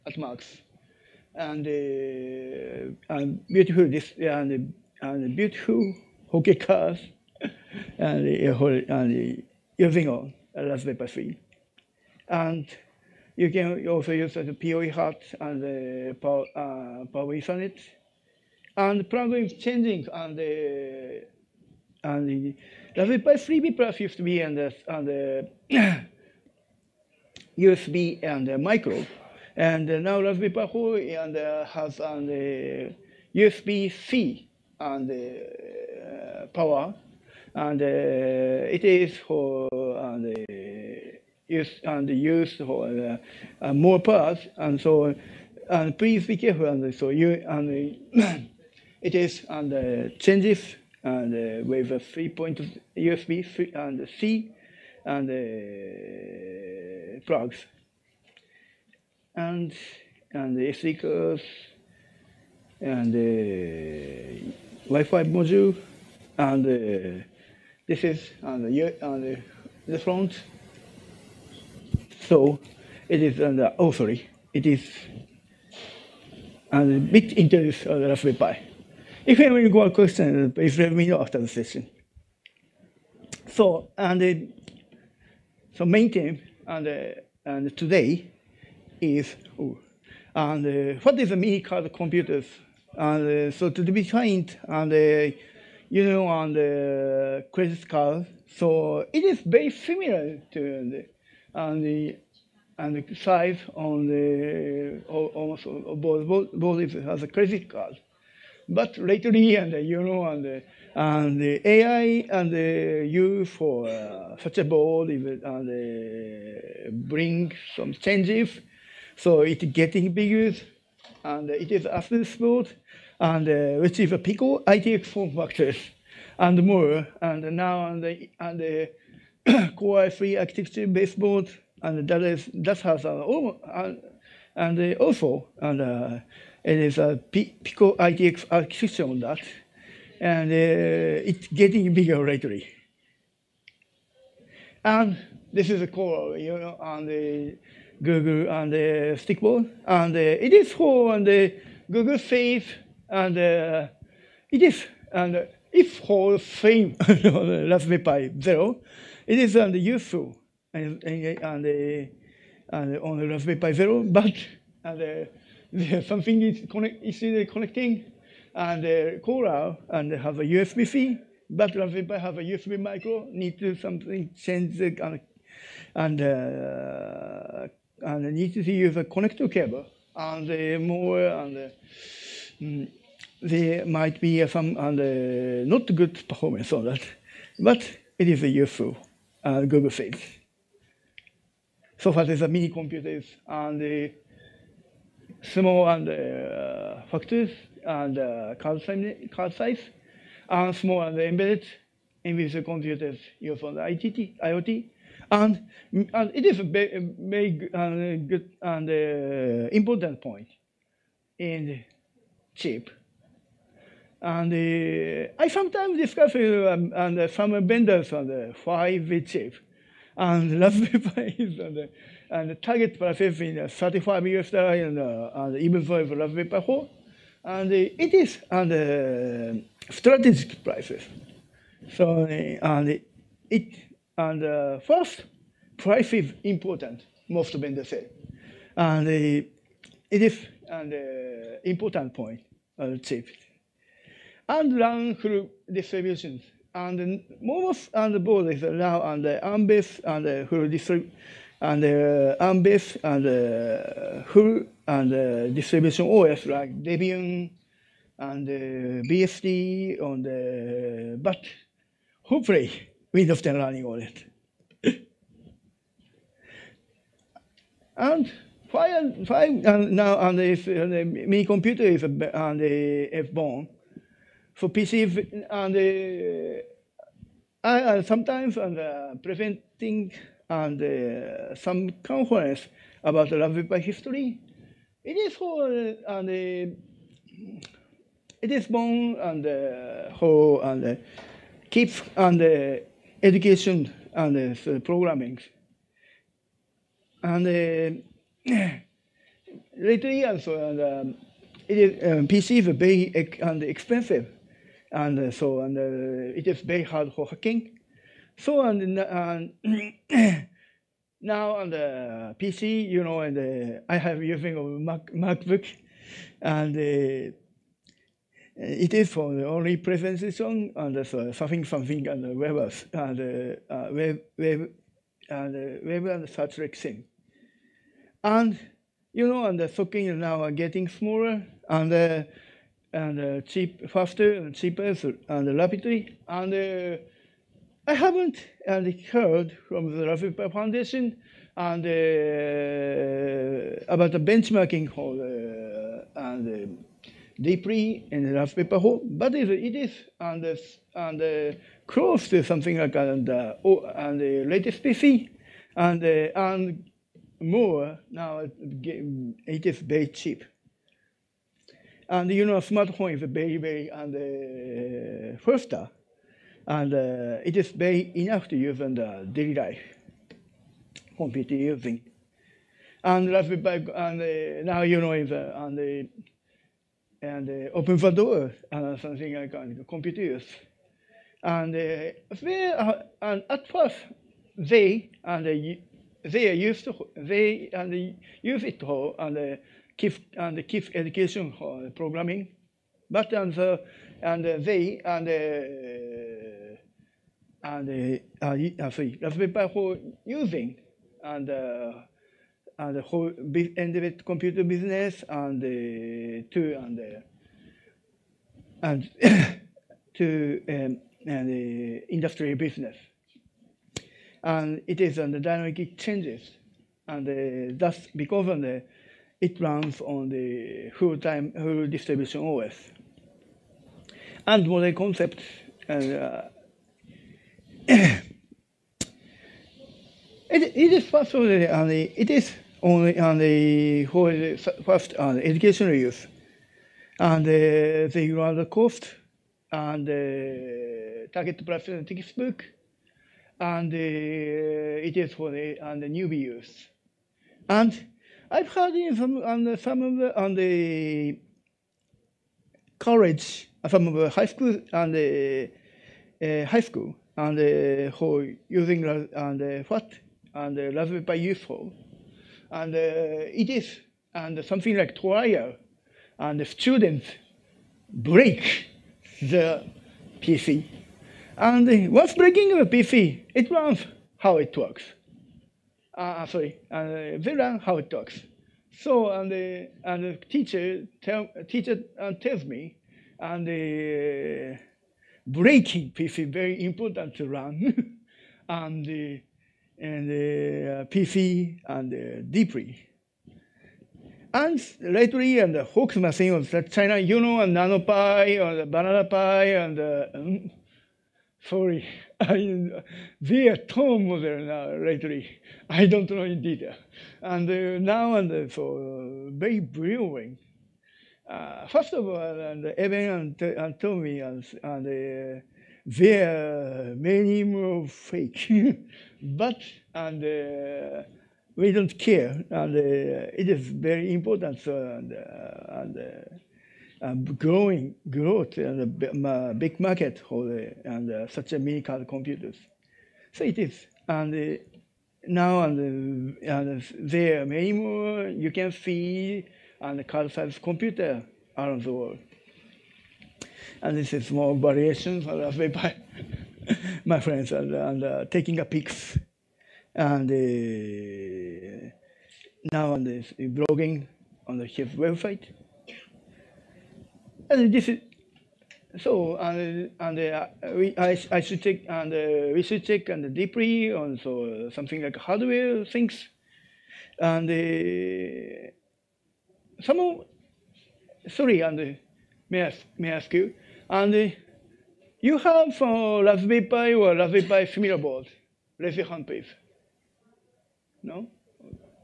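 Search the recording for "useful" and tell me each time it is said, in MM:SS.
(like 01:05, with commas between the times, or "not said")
02:39, 03:08, 07:41.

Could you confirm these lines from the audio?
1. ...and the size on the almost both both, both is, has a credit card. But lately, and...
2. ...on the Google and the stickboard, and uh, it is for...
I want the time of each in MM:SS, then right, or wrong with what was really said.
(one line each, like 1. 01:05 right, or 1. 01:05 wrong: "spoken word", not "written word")
1. 01:42 right
2. 02:26 right.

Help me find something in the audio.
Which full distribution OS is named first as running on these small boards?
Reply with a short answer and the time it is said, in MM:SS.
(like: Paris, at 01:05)
Debian, at 04:16.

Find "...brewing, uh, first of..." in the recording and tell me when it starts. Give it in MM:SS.
08:29.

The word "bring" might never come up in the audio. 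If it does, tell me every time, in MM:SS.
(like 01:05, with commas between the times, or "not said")
01:57.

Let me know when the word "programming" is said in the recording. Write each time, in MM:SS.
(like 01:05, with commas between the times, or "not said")
04:54, 06:31.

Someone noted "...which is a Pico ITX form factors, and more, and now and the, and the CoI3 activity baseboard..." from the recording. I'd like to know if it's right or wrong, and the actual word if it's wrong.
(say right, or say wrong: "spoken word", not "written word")
right.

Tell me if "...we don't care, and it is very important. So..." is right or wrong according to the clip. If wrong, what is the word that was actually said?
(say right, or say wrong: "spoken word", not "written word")
right.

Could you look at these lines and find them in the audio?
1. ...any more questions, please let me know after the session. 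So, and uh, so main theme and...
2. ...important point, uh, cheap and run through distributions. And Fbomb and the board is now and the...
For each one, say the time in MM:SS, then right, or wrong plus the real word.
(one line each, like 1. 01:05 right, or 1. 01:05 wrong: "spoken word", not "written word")
1. 01:19 right
2. 04:01 wrong: "MOMOs", not "Fbomb".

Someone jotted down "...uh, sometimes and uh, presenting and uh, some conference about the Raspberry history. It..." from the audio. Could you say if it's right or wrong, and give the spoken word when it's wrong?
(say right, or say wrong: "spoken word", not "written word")
right.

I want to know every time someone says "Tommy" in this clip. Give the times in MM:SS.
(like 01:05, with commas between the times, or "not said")
08:33.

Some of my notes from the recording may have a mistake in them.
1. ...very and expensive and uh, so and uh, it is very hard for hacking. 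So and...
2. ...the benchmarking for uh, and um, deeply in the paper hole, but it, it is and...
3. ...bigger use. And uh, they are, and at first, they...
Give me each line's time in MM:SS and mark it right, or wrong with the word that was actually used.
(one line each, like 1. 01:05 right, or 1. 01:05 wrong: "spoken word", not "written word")
1. 05:02 right
2. 05:44 right
3. 06:19 wrong: "computer", not "bigger".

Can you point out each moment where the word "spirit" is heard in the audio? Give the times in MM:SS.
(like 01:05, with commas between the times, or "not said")
not said.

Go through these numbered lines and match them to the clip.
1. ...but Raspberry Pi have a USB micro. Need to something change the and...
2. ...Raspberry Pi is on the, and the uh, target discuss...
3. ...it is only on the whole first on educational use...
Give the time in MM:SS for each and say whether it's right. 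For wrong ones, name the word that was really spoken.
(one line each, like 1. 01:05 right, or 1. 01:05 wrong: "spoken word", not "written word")
1. 02:51 right
2. 03:40 wrong: "process", not "discuss"
3. 07:12 right.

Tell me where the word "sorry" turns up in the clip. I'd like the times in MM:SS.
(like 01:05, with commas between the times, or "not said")
01:13, 06:38, 07:56, 08:21, 09:31.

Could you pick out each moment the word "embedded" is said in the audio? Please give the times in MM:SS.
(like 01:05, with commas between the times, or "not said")
03:21, 06:43.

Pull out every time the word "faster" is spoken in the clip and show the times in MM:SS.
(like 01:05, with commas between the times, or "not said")
05:33, 06:05.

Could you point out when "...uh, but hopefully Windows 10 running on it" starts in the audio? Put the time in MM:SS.
04:21.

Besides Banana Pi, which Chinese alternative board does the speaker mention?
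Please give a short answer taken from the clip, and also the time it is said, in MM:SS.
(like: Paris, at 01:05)
NanoPi, at 08:17.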